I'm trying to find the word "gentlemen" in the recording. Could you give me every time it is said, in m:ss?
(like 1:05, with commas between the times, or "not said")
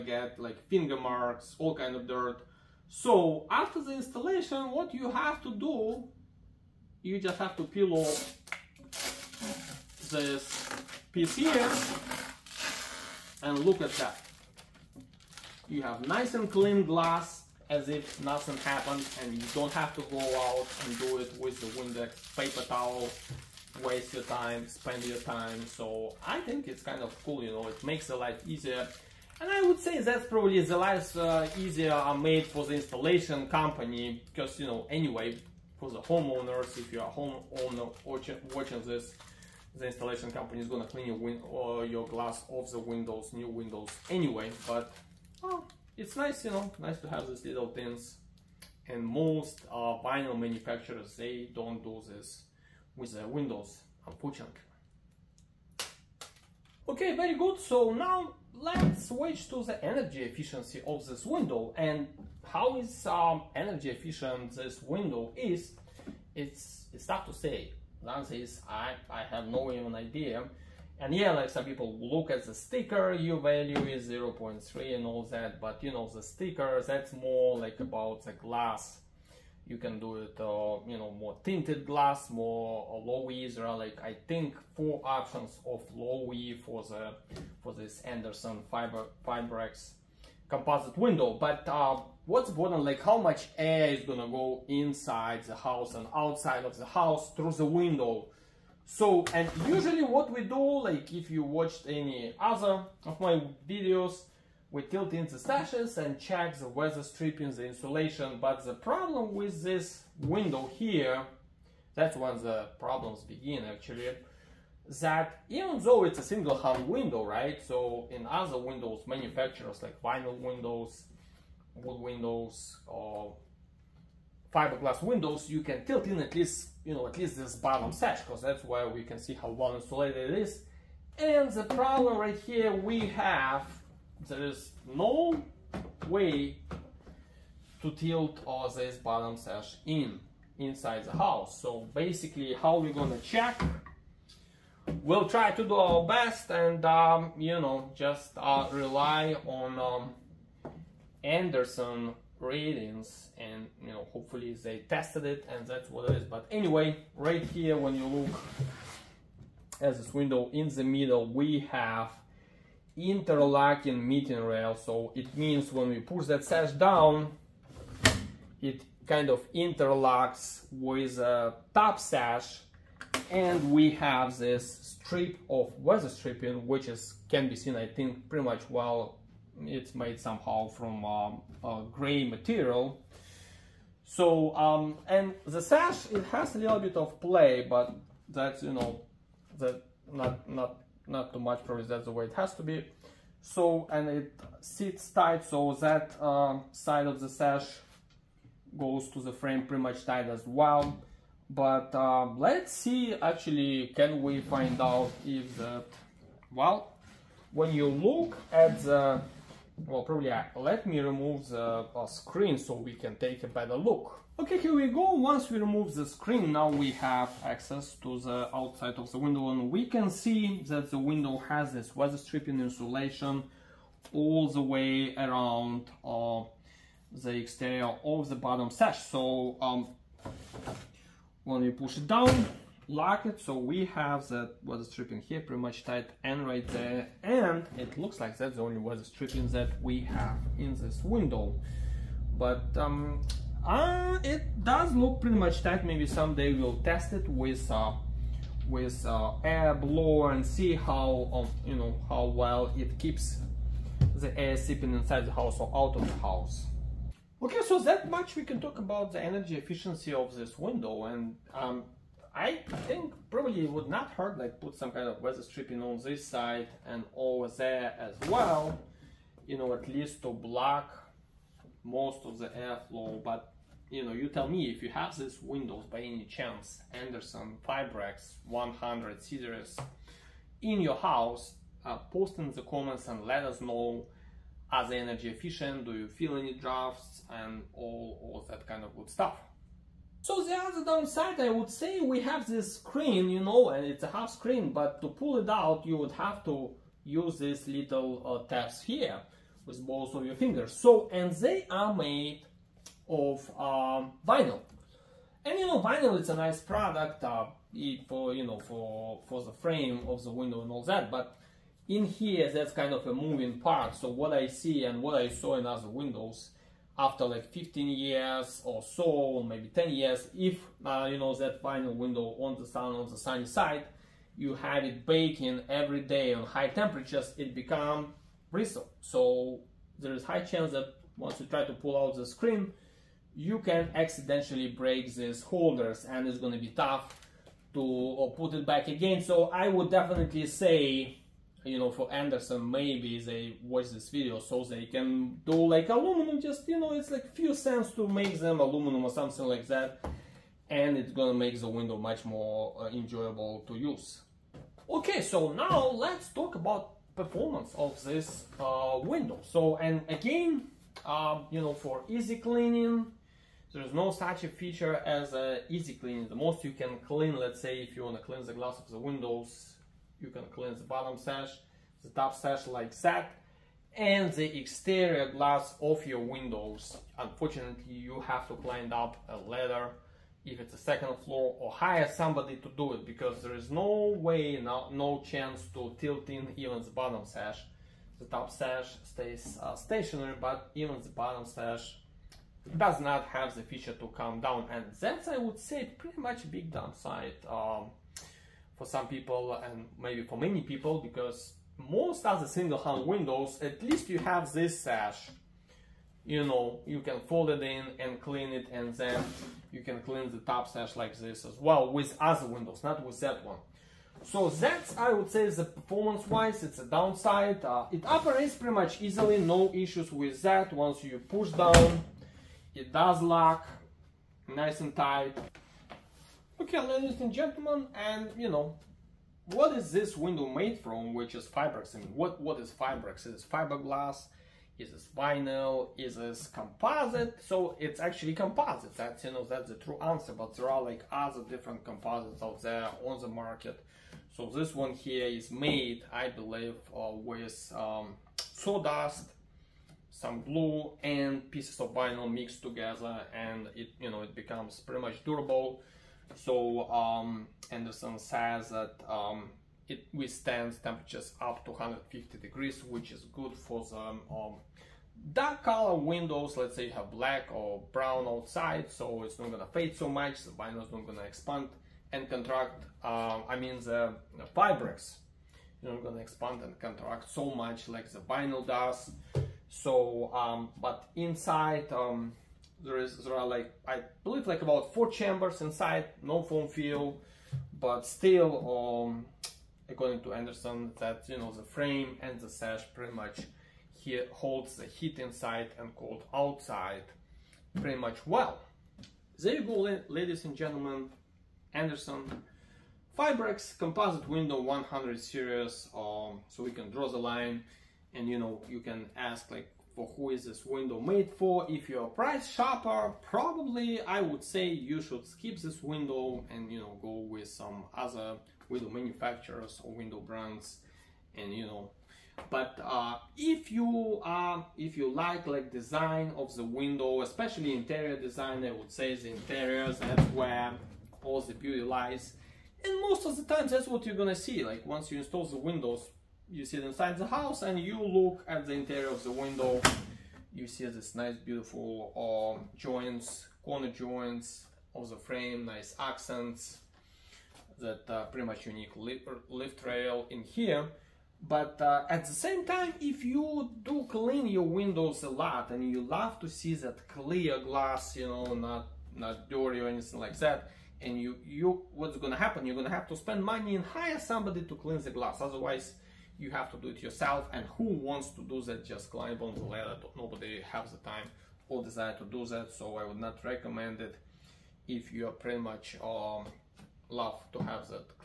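7:07, 8:20.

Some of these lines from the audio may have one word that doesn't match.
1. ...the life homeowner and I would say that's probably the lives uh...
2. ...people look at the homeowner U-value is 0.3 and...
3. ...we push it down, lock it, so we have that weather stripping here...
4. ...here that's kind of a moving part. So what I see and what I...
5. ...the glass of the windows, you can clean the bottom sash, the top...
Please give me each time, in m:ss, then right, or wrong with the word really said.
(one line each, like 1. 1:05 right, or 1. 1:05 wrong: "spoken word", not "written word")
1. 0:28 wrong: "easier", not "homeowner"
2. 1:11 wrong: "sticker", not "homeowner"
3. 3:51 right
4. 5:12 right
5. 6:08 right.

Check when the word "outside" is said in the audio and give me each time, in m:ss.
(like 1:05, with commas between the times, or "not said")
1:36, 3:38, 7:48, 8:16.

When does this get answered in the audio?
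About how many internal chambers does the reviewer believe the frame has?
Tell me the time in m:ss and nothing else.
8:04.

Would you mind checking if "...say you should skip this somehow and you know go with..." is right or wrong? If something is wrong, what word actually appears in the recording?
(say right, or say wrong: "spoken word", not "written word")
wrong: "window", not "somehow".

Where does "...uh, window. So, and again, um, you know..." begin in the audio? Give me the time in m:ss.
5:58.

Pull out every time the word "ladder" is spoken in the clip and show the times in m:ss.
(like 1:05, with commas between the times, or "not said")
6:19, 9:29.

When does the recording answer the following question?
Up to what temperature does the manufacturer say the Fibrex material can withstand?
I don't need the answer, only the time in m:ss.
7:41.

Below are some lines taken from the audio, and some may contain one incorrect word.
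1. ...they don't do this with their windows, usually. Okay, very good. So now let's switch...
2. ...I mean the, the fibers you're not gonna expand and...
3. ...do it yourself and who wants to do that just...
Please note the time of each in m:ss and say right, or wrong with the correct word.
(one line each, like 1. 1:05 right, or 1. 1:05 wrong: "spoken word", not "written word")
1. 0:51 wrong: "unfortunately", not "usually"
2. 7:53 right
3. 9:26 right.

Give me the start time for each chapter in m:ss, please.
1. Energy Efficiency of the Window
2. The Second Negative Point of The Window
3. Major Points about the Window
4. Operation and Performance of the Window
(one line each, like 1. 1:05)
1. 0:57
2. 4:55
3. 8:20
4. 5:57.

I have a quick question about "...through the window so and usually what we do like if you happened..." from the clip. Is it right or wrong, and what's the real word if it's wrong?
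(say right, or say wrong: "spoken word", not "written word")
wrong: "watched", not "happened".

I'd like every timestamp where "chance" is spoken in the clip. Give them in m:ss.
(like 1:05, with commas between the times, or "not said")
4:36, 5:30, 6:25.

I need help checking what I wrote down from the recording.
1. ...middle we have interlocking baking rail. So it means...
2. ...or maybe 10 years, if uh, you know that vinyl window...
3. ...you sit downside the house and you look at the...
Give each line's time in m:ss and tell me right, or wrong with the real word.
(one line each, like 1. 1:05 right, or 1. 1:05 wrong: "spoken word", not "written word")
1. 2:40 wrong: "meeting", not "baking"
2. 5:19 right
3. 8:56 wrong: "inside", not "downside".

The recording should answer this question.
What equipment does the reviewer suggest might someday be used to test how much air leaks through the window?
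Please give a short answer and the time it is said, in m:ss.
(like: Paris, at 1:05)
air blower, at 4:09.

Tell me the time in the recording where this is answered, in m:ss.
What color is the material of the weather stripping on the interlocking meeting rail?
3:01.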